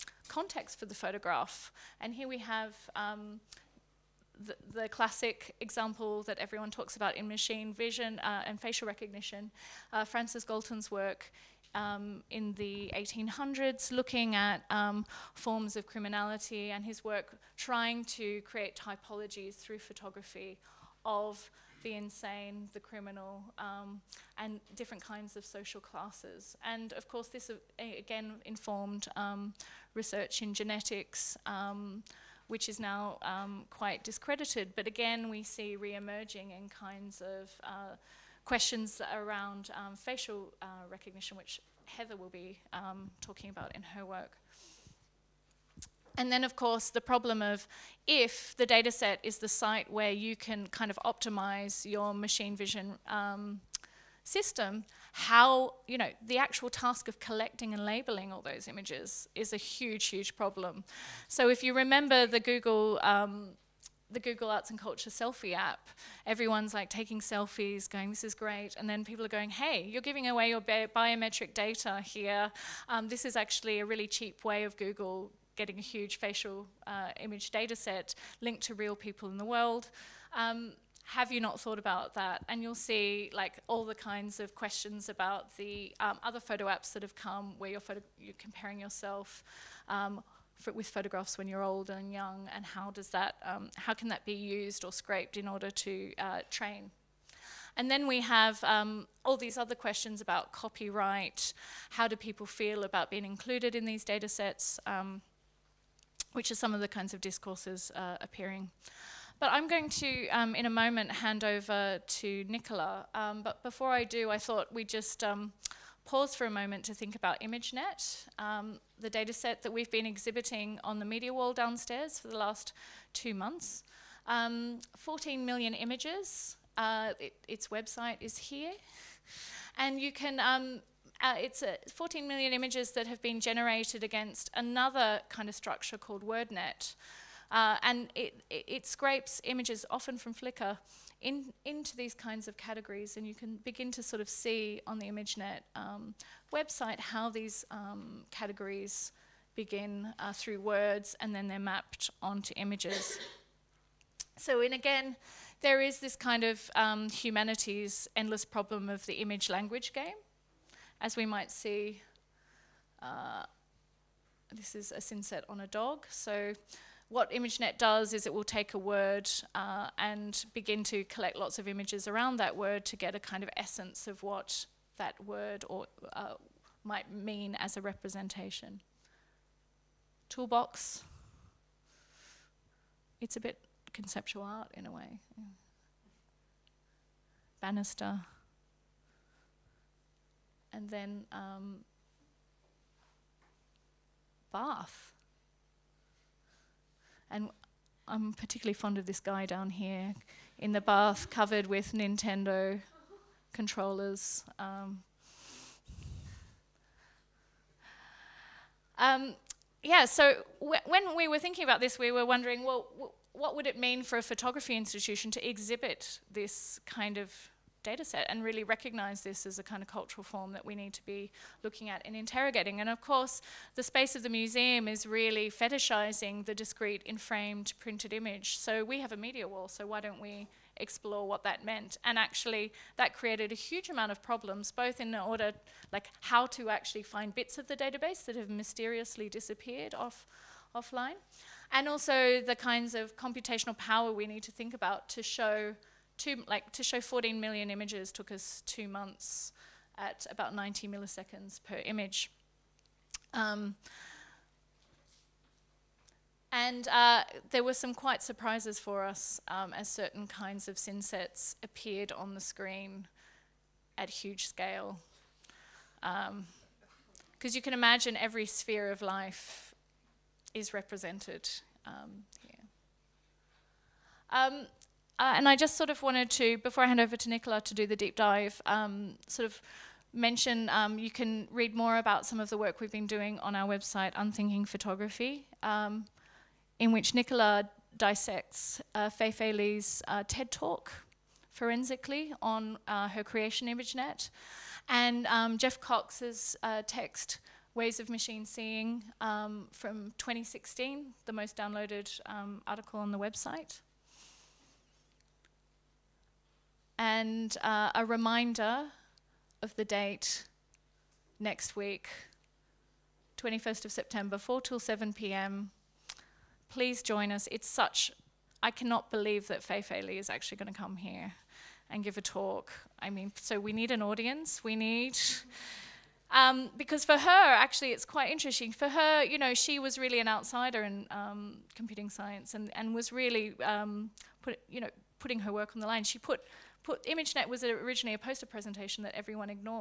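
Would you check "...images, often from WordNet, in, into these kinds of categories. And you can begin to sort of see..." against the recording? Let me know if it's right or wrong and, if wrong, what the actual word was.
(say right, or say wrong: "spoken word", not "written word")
wrong: "Flickr", not "WordNet".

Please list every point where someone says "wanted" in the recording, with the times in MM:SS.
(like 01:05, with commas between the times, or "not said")
04:36.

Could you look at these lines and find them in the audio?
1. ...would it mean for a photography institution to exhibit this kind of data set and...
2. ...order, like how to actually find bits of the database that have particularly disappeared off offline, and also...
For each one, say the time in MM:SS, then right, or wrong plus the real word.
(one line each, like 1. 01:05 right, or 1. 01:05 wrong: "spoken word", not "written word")
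1. 03:33 right
2. 03:55 wrong: "mysteriously", not "particularly".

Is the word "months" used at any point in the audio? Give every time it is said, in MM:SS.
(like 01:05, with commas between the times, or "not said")
02:03, 04:08.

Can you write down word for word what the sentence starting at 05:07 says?
and uh, a reminder of the date next week, 21st of September, 4 till 7 p.m.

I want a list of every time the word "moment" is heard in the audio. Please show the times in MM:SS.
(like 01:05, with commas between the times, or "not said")
01:50, 01:56.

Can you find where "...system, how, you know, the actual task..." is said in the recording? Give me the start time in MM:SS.
00:54.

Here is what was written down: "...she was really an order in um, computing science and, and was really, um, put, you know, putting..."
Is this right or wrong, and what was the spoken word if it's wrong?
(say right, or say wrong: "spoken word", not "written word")
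wrong: "outsider", not "order".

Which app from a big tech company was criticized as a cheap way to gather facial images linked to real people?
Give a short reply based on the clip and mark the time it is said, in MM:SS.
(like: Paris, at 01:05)
Google Arts and Culture selfie app, at 01:04.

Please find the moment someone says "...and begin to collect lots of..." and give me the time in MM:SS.
02:49.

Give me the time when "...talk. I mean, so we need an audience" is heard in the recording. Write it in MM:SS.
05:22.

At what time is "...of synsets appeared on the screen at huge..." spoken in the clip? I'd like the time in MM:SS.
04:20.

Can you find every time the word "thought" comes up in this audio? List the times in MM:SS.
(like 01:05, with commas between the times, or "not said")
01:21, 01:54.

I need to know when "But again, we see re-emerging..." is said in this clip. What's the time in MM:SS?
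00:34.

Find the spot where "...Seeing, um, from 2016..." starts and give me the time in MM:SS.
04:58.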